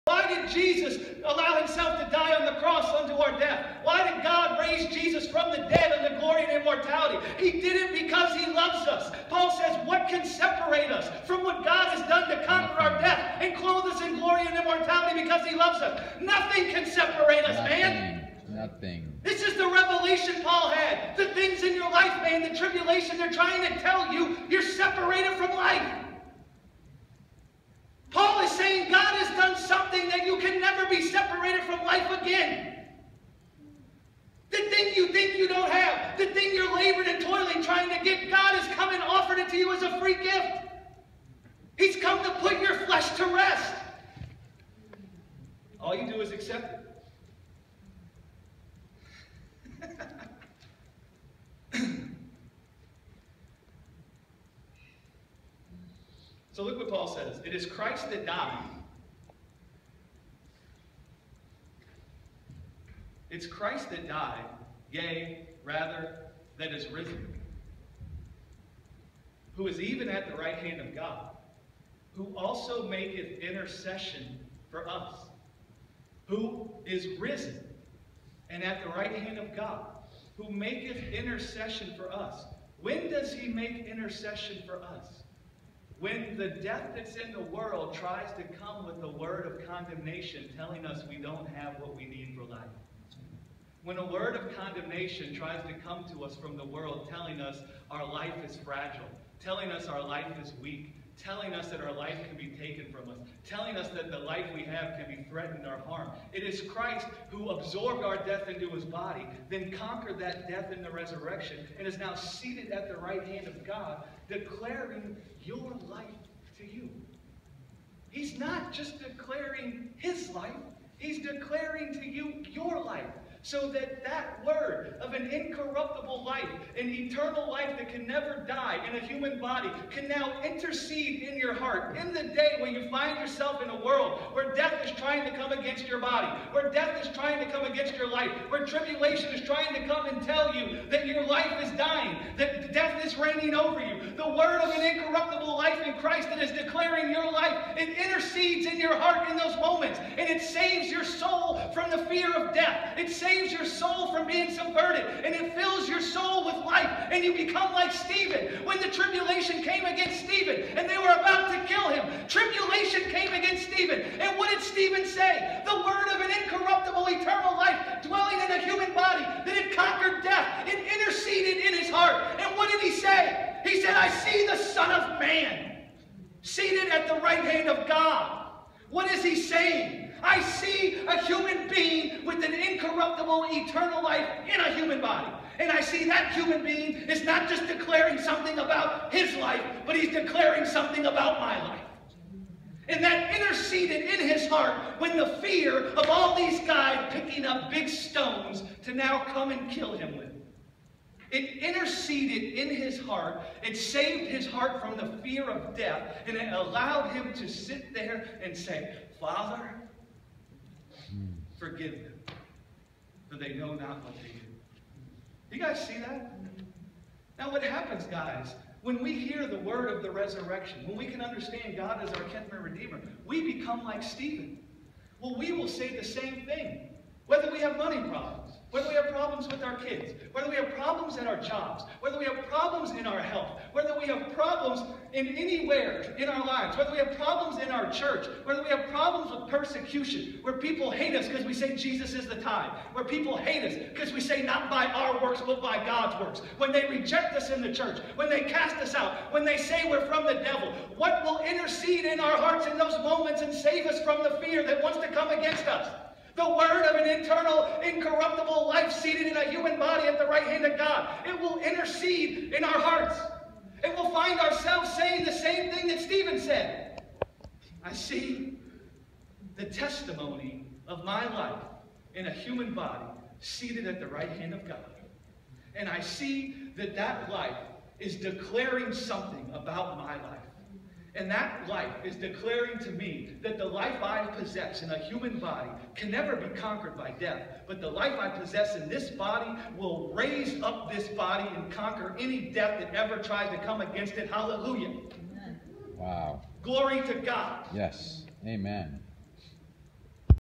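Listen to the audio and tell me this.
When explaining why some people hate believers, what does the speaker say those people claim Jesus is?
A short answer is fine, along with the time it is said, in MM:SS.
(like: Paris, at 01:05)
the tithe, at 04:02.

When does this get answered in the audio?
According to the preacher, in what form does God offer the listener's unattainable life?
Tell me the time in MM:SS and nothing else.
00:39.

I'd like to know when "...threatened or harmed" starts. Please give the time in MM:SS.
01:45.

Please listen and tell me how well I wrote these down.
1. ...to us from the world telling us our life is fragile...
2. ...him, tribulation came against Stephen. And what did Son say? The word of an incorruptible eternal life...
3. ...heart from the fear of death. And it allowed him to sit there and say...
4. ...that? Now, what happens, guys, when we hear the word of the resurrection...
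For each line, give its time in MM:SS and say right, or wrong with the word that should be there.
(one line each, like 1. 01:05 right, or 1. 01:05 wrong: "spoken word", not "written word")
1. 01:36 right
2. 02:41 wrong: "Stephen", not "Son"
3. 03:24 right
4. 03:35 right.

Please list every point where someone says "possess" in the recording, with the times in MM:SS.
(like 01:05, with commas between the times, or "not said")
04:44, 04:48.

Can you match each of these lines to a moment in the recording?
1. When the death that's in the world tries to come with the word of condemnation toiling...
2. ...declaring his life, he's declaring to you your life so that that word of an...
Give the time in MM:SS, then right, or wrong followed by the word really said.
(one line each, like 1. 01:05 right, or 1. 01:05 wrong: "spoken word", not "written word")
1. 01:25 wrong: "telling", not "toiling"
2. 01:58 right.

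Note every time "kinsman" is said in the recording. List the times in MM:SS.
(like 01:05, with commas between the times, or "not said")
03:42.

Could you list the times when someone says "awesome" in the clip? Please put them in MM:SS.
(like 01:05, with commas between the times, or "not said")
not said.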